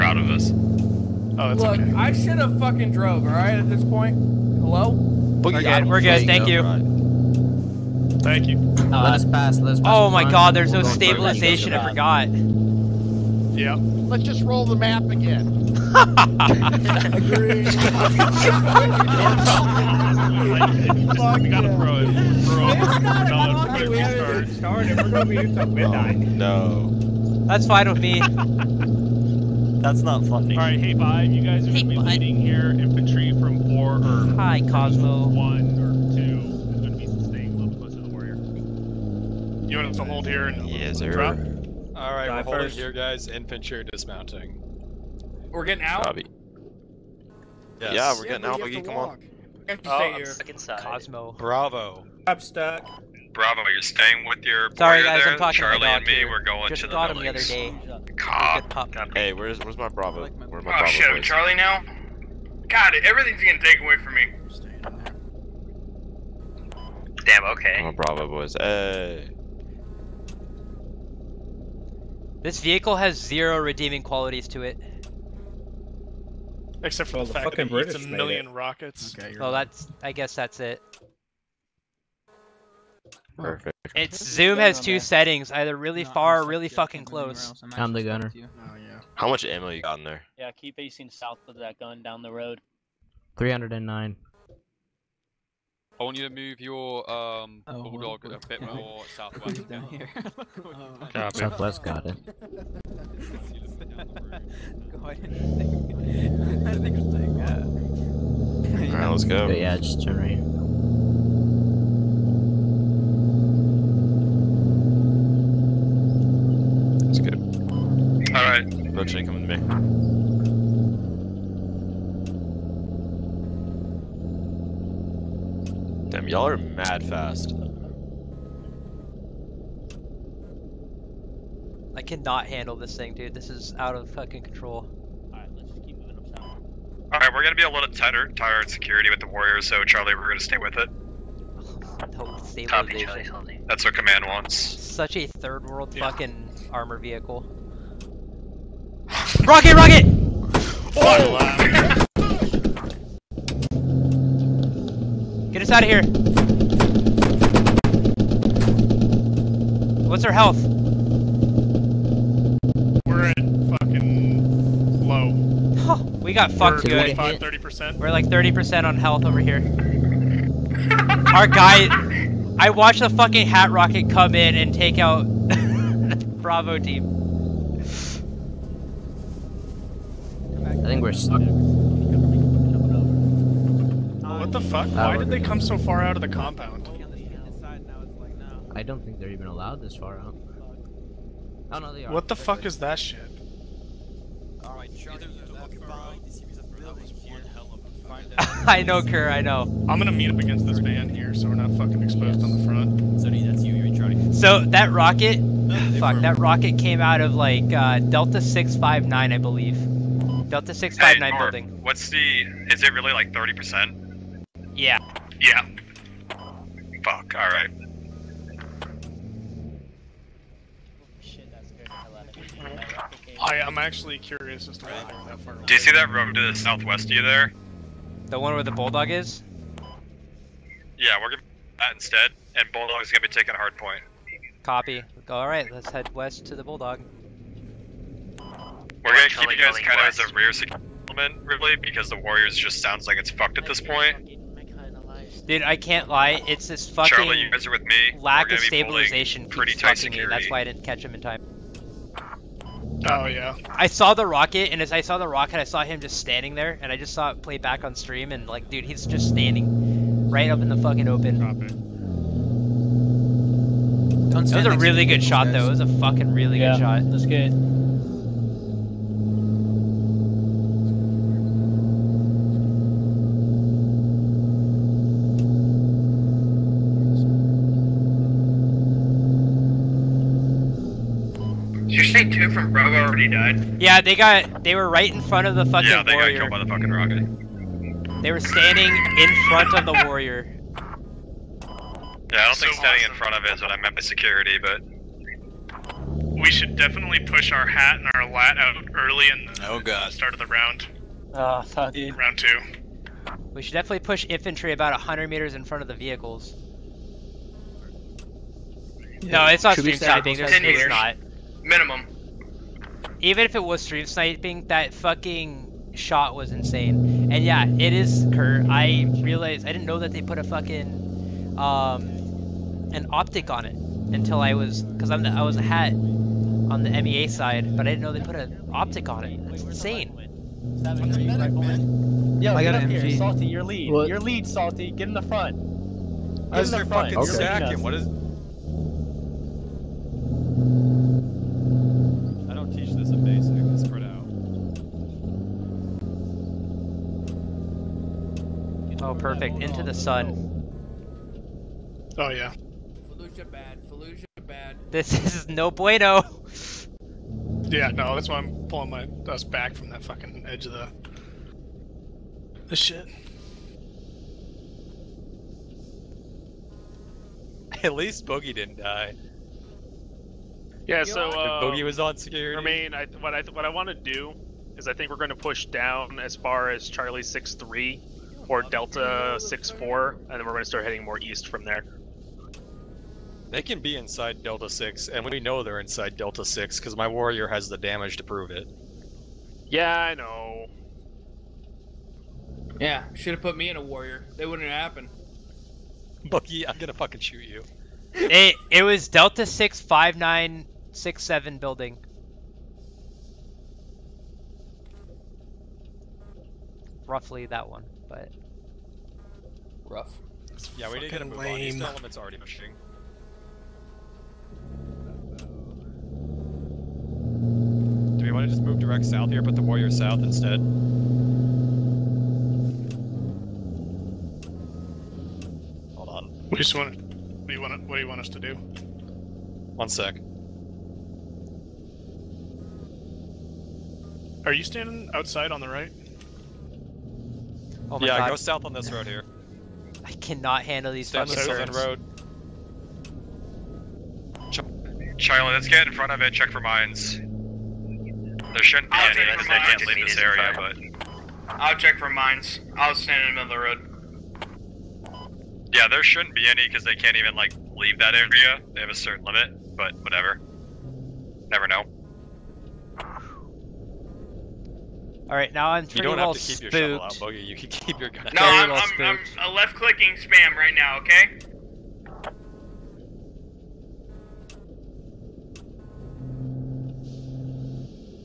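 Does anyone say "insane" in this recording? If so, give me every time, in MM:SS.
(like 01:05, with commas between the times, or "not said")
05:16, 05:29.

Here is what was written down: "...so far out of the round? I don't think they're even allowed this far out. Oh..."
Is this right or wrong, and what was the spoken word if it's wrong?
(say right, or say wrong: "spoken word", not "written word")
wrong: "compound", not "round".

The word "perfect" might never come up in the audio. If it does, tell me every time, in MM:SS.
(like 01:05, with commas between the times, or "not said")
01:23, 05:49.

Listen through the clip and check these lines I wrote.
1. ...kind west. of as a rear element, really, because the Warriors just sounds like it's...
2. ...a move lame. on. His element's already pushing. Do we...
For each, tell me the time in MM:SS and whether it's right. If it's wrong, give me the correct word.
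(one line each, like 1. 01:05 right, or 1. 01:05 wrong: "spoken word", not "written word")
1. 03:59 right
2. 06:51 right.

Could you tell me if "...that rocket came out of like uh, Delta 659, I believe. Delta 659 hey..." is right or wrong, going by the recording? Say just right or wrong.
right.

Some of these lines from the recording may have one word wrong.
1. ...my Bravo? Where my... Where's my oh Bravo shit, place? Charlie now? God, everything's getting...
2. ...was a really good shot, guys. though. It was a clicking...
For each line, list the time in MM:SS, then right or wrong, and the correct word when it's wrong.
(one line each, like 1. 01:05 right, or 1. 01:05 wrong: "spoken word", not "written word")
1. 00:59 right
2. 04:24 wrong: "fucking", not "clicking".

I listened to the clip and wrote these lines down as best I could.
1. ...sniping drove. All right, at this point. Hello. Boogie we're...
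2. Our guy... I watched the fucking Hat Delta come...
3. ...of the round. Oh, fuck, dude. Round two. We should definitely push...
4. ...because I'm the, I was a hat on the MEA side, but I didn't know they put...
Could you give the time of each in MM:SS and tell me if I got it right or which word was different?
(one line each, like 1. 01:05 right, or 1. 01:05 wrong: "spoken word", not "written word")
1. 00:02 wrong: "fucking", not "sniping"
2. 02:51 wrong: "Rocket", not "Delta"
3. 05:00 right
4. 05:24 right.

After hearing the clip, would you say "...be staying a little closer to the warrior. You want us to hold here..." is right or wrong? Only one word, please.
right.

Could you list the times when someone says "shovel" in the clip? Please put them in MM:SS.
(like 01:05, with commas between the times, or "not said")
07:46.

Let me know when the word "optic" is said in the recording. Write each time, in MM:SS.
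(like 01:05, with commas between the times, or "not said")
05:23, 05:28.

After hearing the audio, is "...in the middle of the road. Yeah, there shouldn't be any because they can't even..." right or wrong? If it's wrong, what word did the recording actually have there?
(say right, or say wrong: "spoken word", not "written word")
right.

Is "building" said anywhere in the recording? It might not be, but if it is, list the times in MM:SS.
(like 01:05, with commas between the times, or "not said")
03:31, 06:41.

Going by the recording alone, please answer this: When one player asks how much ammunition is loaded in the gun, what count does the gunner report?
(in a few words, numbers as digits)
309.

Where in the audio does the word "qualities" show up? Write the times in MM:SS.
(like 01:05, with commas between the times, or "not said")
01:14.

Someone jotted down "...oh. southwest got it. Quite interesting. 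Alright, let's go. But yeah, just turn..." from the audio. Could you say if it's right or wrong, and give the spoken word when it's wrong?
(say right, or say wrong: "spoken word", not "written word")
right.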